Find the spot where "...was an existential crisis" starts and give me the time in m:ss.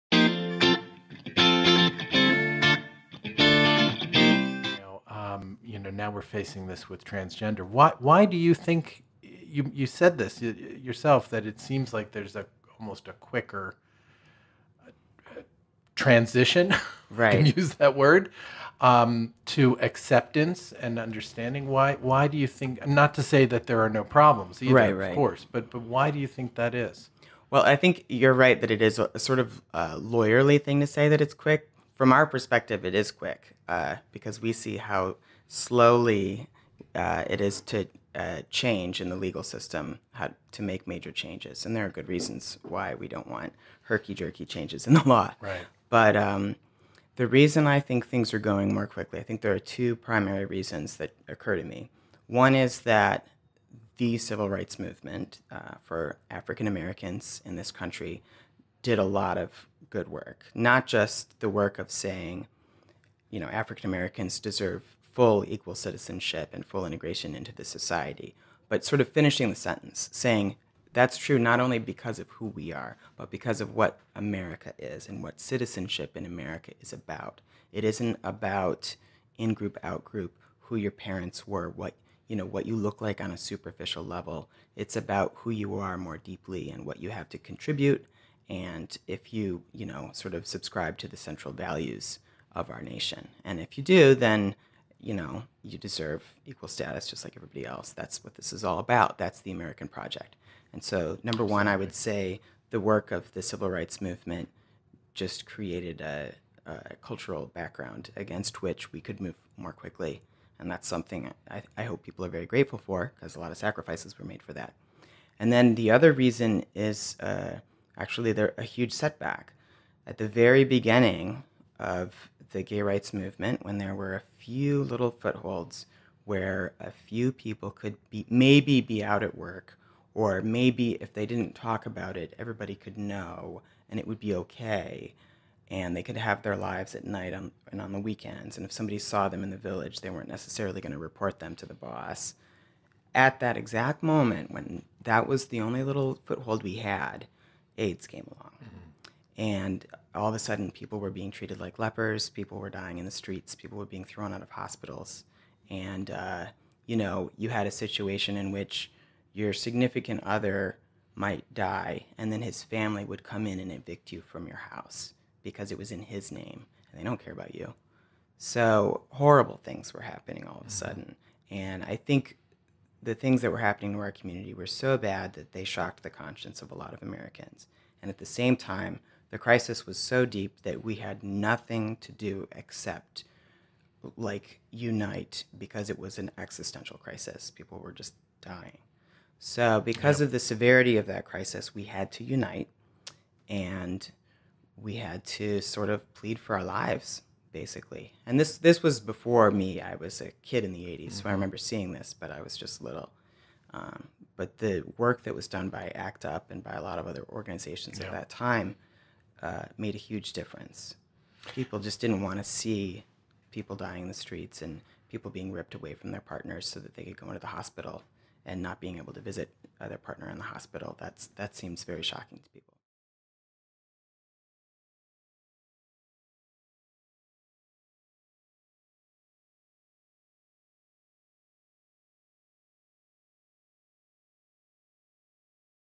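3:05.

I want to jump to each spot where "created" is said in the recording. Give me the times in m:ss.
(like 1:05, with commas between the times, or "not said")
1:45.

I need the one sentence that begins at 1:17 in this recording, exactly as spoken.
It isn't about in group, out group, who your parents were, what you know, what you look like on a superficial level.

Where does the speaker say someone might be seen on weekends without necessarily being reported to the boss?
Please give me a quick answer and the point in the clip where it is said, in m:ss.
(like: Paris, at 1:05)
The Village, at 2:19.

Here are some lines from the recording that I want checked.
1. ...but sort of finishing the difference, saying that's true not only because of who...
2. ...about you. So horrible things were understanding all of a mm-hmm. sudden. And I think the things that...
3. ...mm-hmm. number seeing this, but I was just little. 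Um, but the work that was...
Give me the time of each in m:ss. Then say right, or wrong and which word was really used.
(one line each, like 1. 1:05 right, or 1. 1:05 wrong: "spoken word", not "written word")
1. 1:08 wrong: "sentence", not "difference"
2. 2:47 wrong: "happening", not "understanding"
3. 3:21 wrong: "remember", not "number".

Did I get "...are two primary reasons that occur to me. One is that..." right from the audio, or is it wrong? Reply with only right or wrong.
right.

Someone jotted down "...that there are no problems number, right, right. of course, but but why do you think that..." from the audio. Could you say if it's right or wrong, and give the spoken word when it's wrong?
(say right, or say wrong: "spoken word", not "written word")
wrong: "either", not "number".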